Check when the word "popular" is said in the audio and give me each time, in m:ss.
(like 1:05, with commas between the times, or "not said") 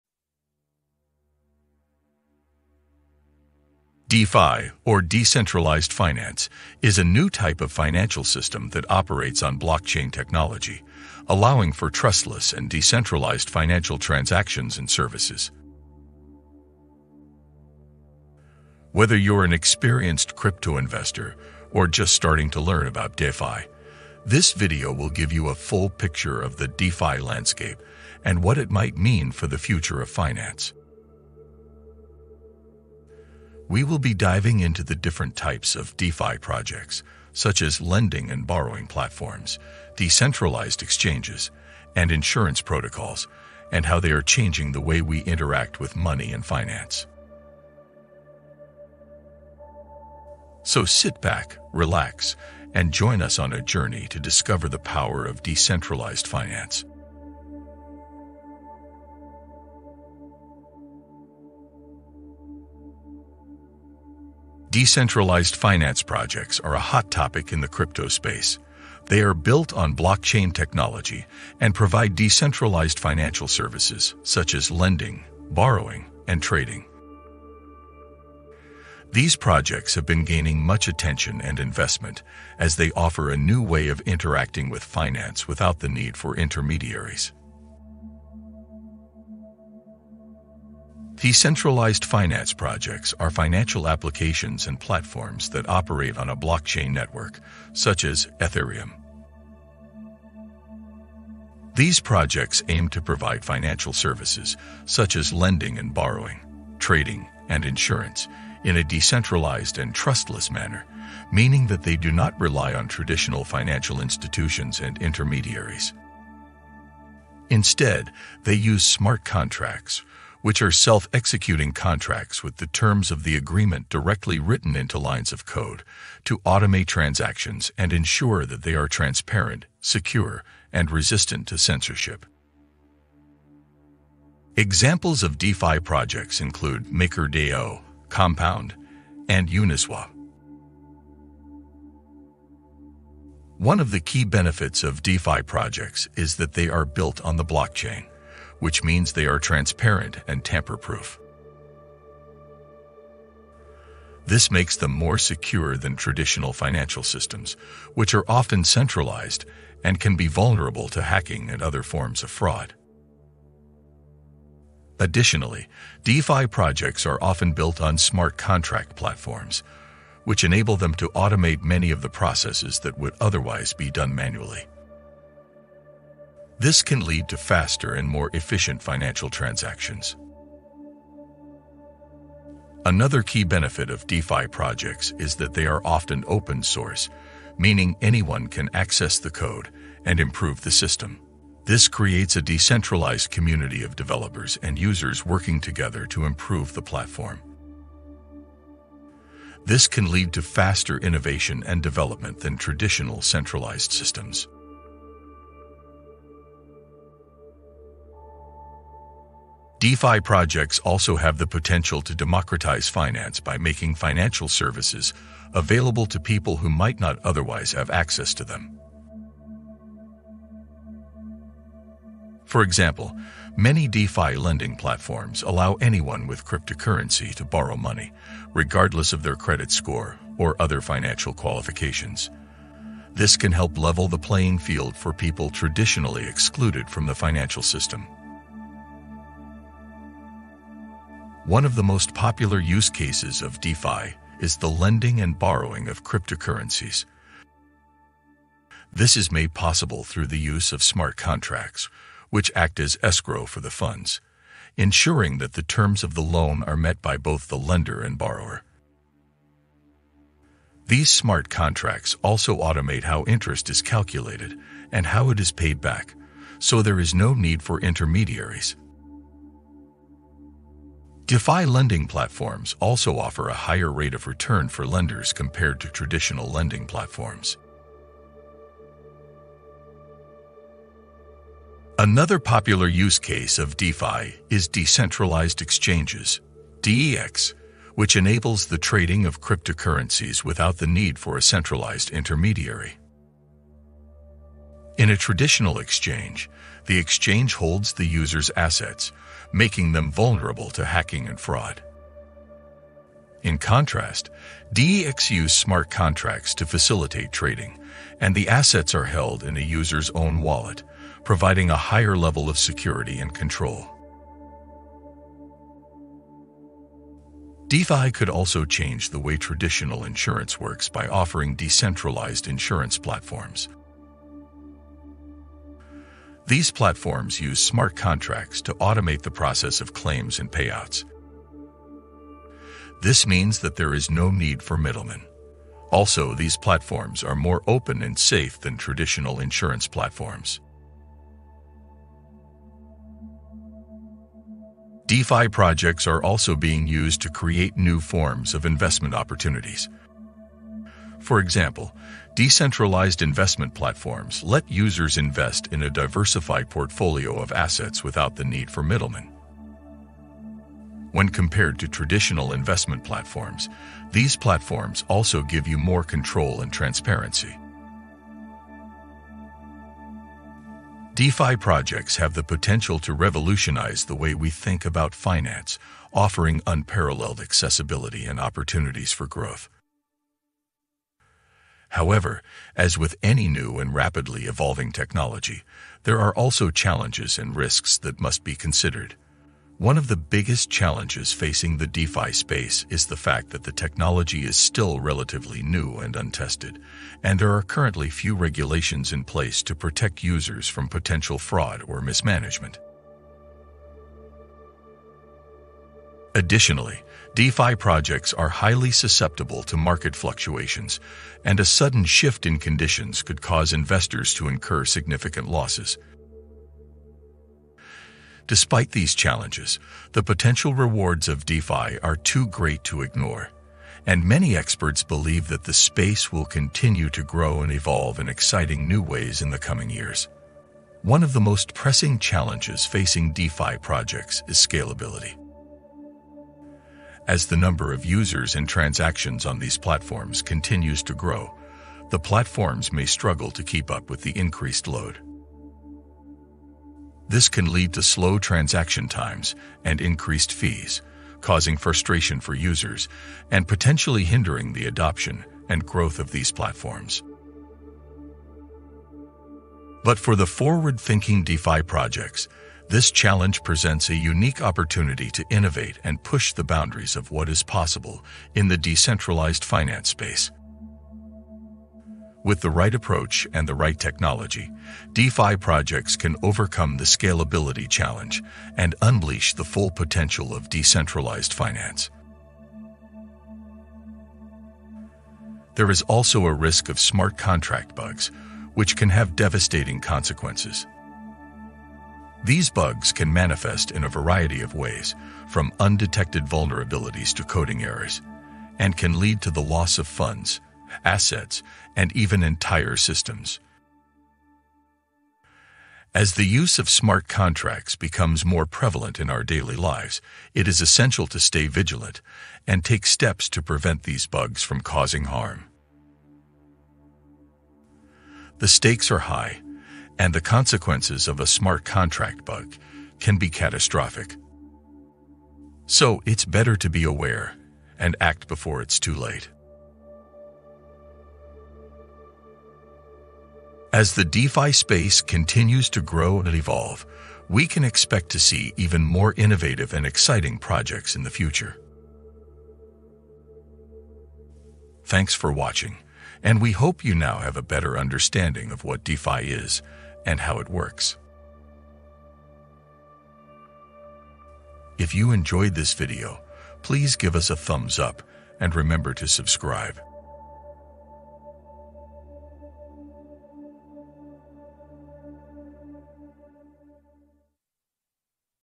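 4:02, 4:42.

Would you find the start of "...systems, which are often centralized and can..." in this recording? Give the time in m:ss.
2:37.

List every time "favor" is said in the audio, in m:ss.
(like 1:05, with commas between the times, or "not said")
not said.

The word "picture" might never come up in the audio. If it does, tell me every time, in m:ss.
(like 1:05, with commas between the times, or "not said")
0:25.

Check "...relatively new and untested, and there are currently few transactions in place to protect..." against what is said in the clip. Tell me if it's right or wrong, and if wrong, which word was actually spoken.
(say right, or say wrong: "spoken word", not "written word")
wrong: "regulations", not "transactions".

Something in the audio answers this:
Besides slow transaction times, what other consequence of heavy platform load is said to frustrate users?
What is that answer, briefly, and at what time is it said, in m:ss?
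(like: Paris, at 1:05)
increased fees, at 7:30.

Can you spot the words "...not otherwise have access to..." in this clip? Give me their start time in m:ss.
3:36.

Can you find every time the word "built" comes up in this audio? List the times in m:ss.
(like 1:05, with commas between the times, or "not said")
1:09, 2:26, 2:47.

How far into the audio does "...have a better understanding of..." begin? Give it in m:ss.
9:07.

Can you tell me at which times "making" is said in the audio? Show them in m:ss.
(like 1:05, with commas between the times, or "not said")
3:33, 4:59.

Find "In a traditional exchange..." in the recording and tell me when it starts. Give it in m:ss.
4:54.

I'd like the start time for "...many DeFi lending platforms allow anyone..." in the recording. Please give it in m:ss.
3:43.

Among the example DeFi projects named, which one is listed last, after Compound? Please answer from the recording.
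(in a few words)
Uniswap.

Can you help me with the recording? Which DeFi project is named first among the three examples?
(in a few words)
MakerDAO.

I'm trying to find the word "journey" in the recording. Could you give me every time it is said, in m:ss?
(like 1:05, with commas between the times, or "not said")
0:53.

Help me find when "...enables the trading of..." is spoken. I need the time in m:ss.
4:48.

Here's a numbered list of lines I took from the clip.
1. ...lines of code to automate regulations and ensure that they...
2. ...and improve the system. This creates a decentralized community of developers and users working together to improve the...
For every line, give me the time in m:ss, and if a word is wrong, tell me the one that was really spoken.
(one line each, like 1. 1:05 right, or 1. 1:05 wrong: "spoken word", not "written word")
1. 2:04 wrong: "transactions", not "regulations"
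2. 3:10 right.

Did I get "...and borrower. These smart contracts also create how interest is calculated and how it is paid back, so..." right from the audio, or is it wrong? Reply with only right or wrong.
wrong.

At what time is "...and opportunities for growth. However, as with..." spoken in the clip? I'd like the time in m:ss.
6:18.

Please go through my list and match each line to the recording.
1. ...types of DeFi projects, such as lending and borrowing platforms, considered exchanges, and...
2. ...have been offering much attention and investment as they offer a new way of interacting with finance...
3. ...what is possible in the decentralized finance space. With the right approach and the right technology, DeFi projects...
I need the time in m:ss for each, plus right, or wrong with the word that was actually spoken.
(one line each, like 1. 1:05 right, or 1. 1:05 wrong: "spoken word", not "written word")
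1. 0:35 wrong: "decentralized", not "considered"
2. 1:19 wrong: "gaining", not "offering"
3. 7:47 right.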